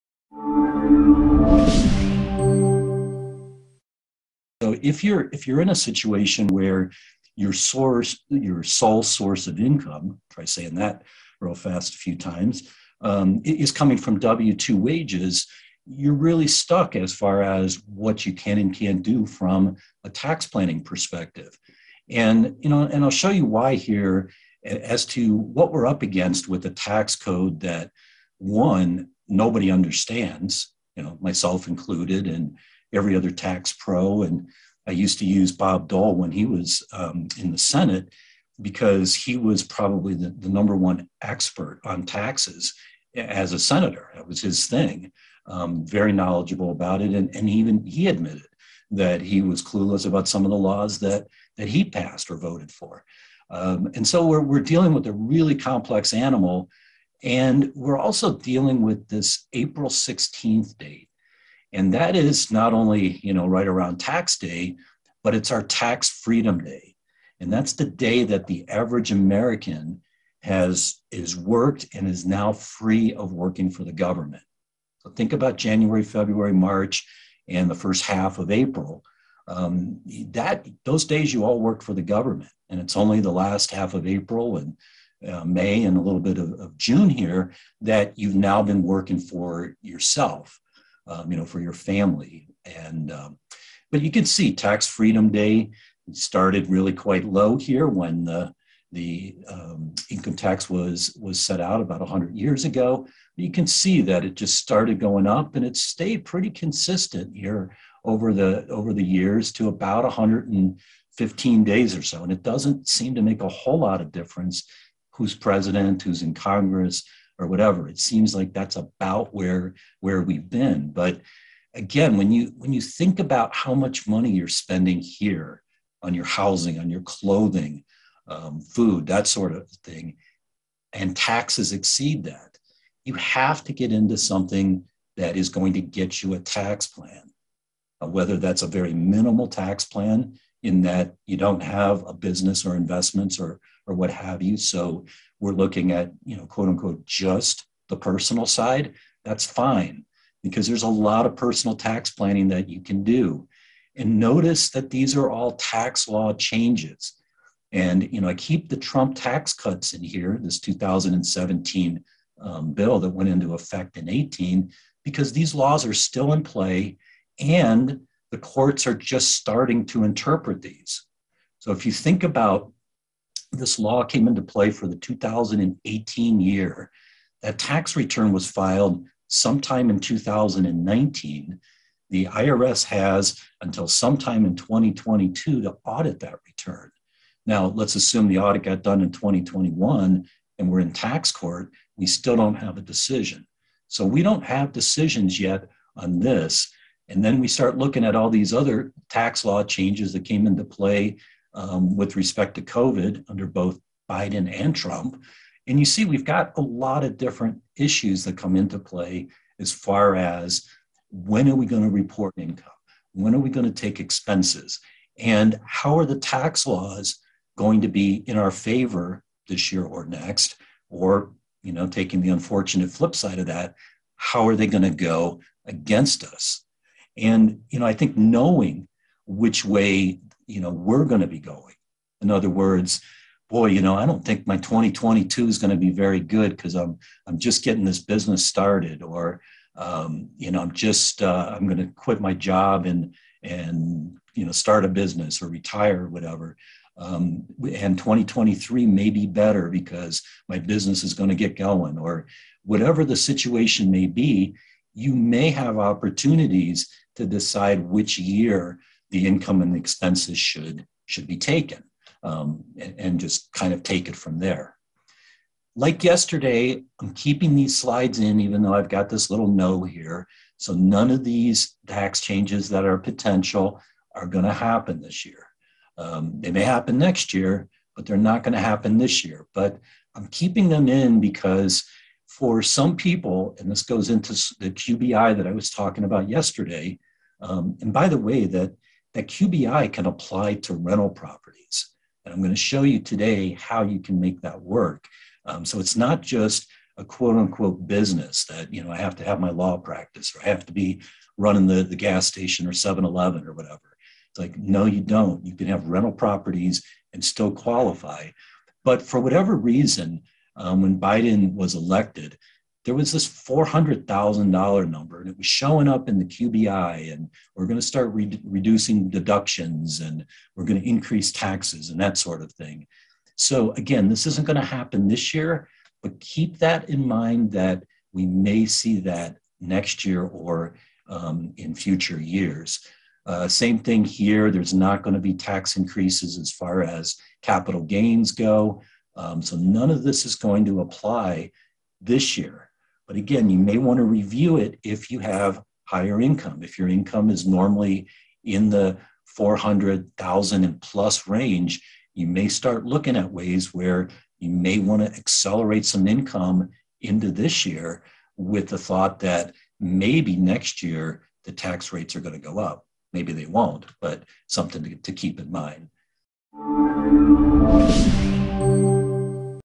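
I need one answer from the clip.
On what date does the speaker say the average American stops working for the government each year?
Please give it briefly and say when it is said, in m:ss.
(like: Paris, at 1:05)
April 16th, at 0:59.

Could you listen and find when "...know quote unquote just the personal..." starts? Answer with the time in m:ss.
2:26.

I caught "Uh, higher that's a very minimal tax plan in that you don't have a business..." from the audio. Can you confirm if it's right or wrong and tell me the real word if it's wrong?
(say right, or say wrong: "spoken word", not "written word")
wrong: "whether", not "higher".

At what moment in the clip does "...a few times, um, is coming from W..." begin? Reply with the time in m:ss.
0:11.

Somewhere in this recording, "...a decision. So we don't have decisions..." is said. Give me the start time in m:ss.
3:12.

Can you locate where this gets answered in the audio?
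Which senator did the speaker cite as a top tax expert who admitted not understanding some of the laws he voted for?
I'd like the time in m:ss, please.
0:35.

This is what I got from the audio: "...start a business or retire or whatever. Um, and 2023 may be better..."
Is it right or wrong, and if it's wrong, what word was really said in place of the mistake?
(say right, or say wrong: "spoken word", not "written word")
right.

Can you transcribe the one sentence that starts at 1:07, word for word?
And that's the day that the average American has is worked and is now free of working for the government.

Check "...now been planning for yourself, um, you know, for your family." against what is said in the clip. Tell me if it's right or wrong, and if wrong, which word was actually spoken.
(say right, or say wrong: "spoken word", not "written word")
wrong: "working", not "planning".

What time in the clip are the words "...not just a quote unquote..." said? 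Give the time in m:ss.
4:55.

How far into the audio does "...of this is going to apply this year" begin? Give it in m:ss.
5:39.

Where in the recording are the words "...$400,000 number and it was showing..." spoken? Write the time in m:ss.
5:13.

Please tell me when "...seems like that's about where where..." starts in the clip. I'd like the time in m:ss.
1:57.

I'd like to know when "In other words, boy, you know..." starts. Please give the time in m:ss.
3:52.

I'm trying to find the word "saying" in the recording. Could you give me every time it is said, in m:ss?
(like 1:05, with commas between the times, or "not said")
0:10.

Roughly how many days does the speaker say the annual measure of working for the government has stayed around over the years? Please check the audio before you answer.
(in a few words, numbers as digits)
115 days.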